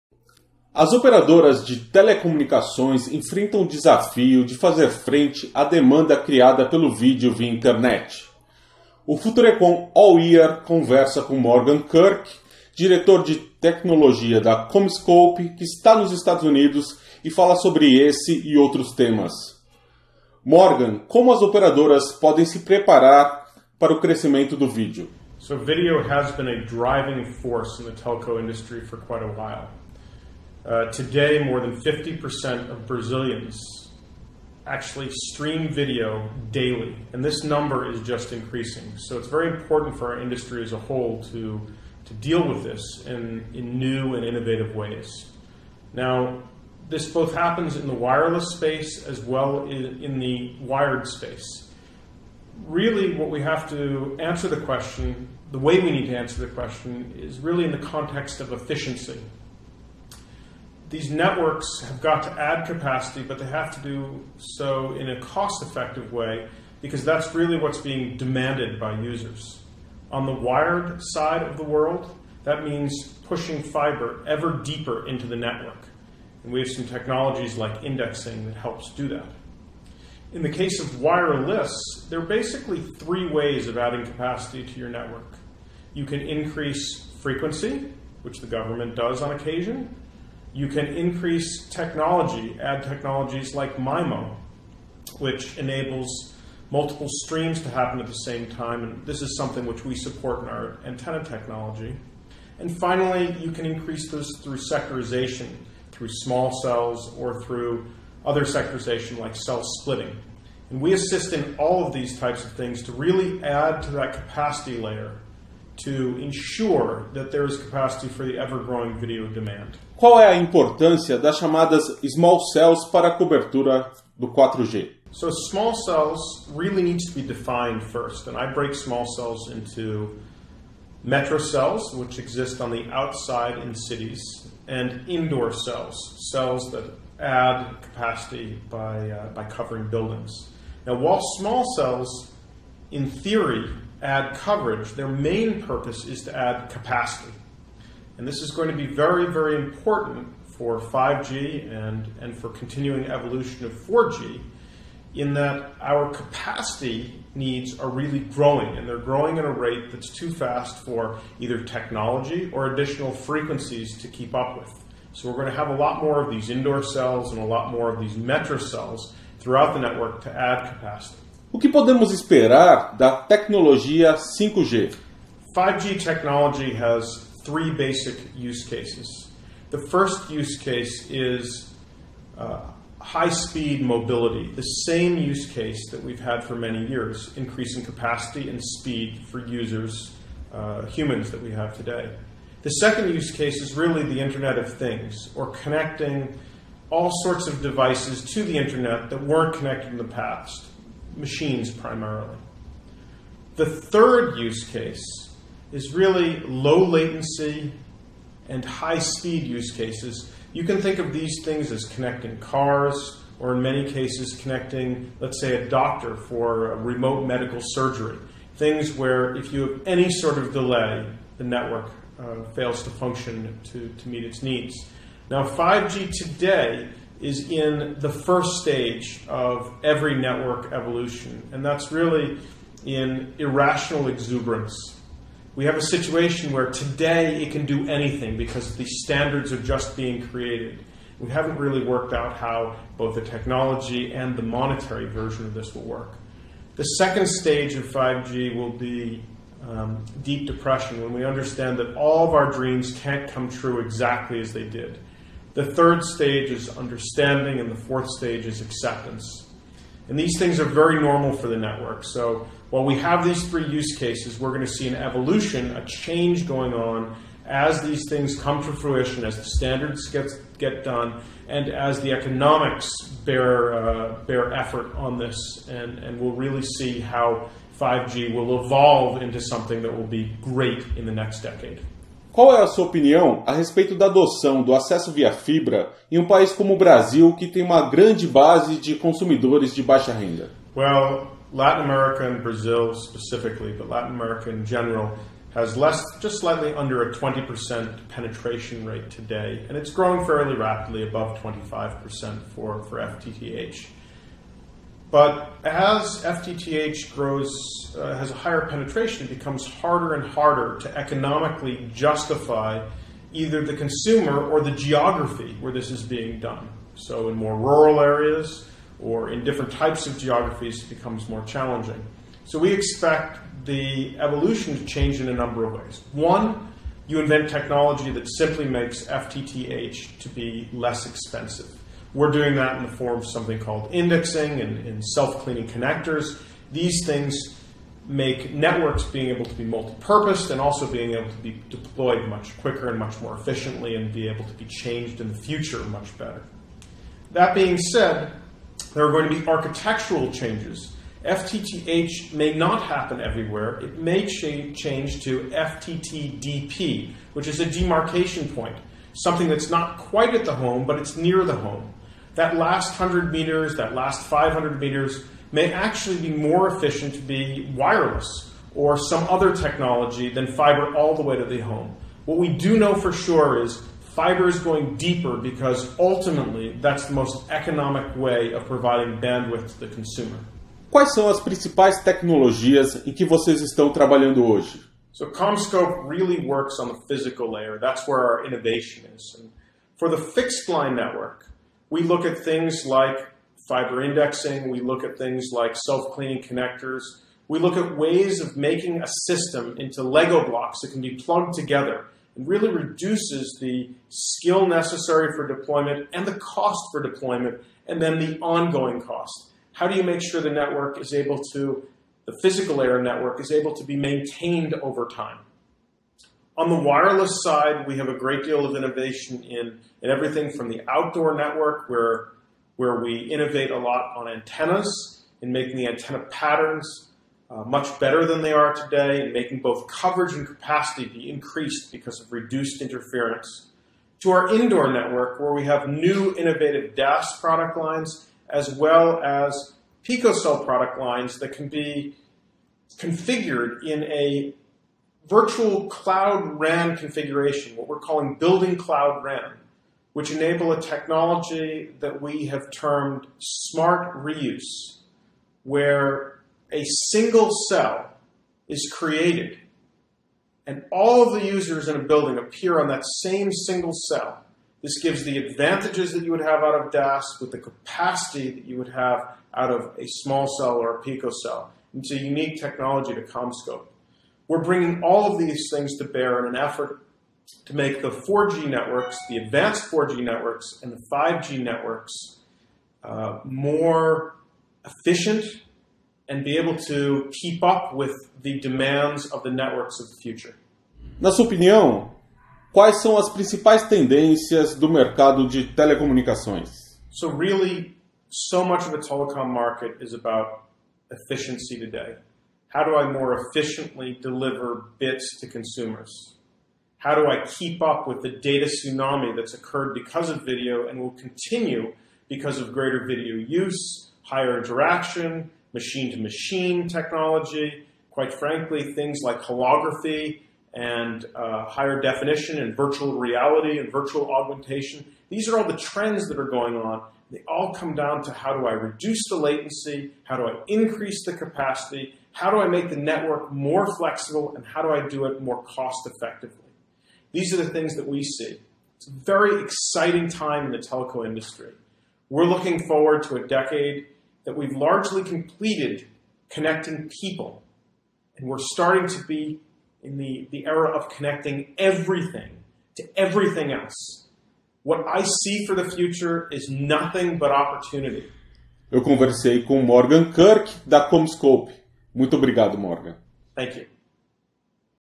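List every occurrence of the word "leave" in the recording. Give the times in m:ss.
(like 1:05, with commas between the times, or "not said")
not said.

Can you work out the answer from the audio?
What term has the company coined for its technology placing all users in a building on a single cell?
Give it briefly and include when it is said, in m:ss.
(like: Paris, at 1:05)
smart reuse, at 7:33.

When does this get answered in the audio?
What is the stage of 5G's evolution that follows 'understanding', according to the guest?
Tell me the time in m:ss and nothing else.
4:18.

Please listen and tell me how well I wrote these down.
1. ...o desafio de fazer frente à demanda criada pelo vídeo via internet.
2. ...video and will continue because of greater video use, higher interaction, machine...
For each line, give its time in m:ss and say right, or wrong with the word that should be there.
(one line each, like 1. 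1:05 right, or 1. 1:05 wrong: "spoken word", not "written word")
1. 0:03 right
2. 8:30 right.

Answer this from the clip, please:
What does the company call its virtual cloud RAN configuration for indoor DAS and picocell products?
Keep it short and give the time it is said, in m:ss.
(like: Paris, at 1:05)
building cloud RAN, at 7:28.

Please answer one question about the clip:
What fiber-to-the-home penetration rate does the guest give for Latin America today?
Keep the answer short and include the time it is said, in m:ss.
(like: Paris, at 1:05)
just under 20%, at 4:56.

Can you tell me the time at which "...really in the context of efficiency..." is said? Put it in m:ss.
0:57.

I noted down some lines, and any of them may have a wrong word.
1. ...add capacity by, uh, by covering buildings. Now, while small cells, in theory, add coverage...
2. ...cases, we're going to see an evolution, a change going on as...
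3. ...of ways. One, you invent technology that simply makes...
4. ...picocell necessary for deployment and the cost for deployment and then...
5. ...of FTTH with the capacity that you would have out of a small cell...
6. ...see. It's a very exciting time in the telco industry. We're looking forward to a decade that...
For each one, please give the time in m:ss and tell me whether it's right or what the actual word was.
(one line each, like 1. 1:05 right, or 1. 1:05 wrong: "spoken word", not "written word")
1. 2:17 right
2. 4:23 right
3. 5:25 right
4. 6:44 wrong: "skill", not "picocell"
5. 7:46 wrong: "DAS", not "FTTH"
6. 8:58 right.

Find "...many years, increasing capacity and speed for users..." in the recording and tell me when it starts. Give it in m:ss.
3:06.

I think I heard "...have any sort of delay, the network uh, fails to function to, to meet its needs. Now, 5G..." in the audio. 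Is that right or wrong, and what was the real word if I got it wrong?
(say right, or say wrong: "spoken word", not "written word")
right.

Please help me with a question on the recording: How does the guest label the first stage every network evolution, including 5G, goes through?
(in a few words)
irrational exuberance.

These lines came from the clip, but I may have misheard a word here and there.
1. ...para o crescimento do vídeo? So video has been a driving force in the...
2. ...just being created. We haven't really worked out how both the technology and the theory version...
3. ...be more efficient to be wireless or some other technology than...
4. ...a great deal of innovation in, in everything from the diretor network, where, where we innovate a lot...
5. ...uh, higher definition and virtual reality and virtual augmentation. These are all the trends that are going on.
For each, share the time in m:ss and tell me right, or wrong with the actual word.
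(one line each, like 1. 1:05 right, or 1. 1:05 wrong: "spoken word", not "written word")
1. 0:23 right
2. 3:59 wrong: "monetary", not "theory"
3. 6:06 right
4. 6:58 wrong: "outdoor", not "diretor"
5. 8:41 right.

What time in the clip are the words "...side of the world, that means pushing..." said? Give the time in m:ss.
1:10.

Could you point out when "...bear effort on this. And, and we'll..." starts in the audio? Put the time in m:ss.
4:34.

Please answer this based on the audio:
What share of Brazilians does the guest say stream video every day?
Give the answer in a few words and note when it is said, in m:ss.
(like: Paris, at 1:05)
more than 50%, at 0:31.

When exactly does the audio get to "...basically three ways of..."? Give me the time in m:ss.
1:22.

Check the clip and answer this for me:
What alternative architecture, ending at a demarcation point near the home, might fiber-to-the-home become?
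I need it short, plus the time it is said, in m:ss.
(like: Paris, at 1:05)
FTTDP, at 5:55.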